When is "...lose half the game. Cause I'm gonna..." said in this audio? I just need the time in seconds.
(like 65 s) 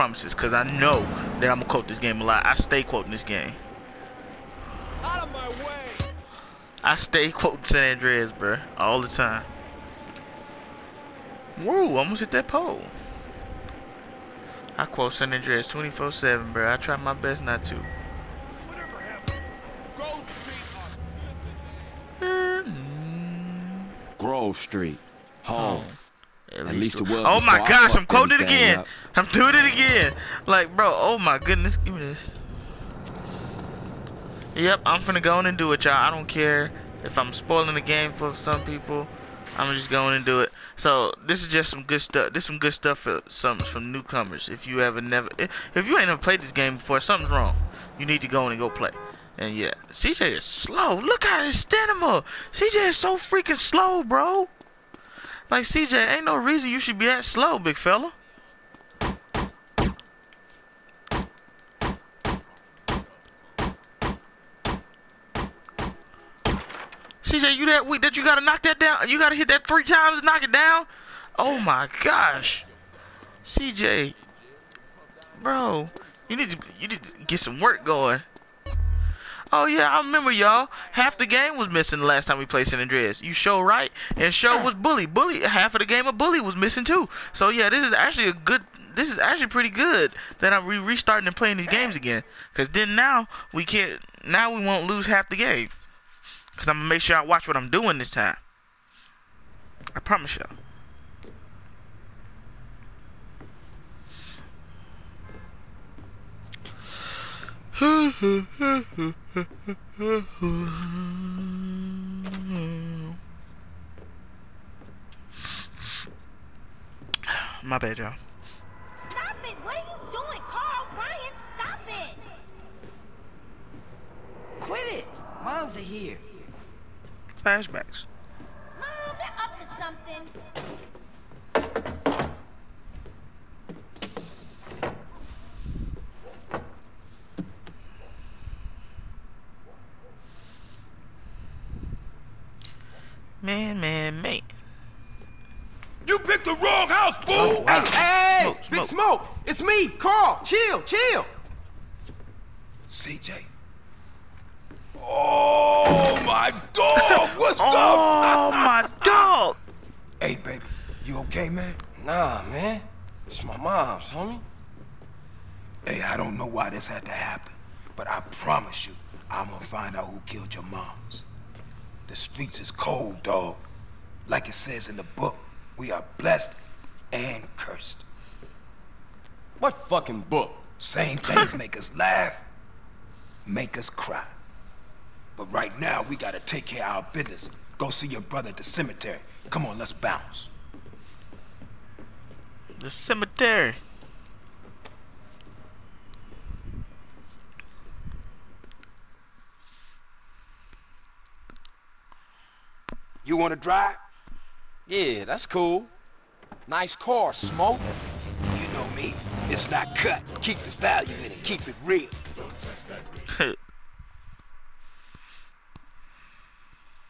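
94 s.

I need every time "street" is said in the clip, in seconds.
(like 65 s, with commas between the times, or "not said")
24 s, 172 s.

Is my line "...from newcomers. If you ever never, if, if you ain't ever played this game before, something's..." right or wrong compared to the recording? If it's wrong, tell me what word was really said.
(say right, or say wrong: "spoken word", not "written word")
right.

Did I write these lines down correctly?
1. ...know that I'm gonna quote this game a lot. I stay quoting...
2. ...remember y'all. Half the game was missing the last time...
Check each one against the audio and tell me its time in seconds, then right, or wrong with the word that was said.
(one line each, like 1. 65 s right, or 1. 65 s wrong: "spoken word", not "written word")
1. 0 s right
2. 79 s right.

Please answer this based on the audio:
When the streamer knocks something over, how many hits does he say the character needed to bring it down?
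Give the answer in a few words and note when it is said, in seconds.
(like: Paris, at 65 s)
3, at 69 s.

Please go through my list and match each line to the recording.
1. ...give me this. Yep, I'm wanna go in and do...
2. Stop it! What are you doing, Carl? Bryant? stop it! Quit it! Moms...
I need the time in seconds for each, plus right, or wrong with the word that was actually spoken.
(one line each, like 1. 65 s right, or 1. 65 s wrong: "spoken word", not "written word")
1. 31 s wrong: "finna", not "wanna"
2. 119 s right.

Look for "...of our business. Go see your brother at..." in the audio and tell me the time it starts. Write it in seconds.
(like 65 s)
186 s.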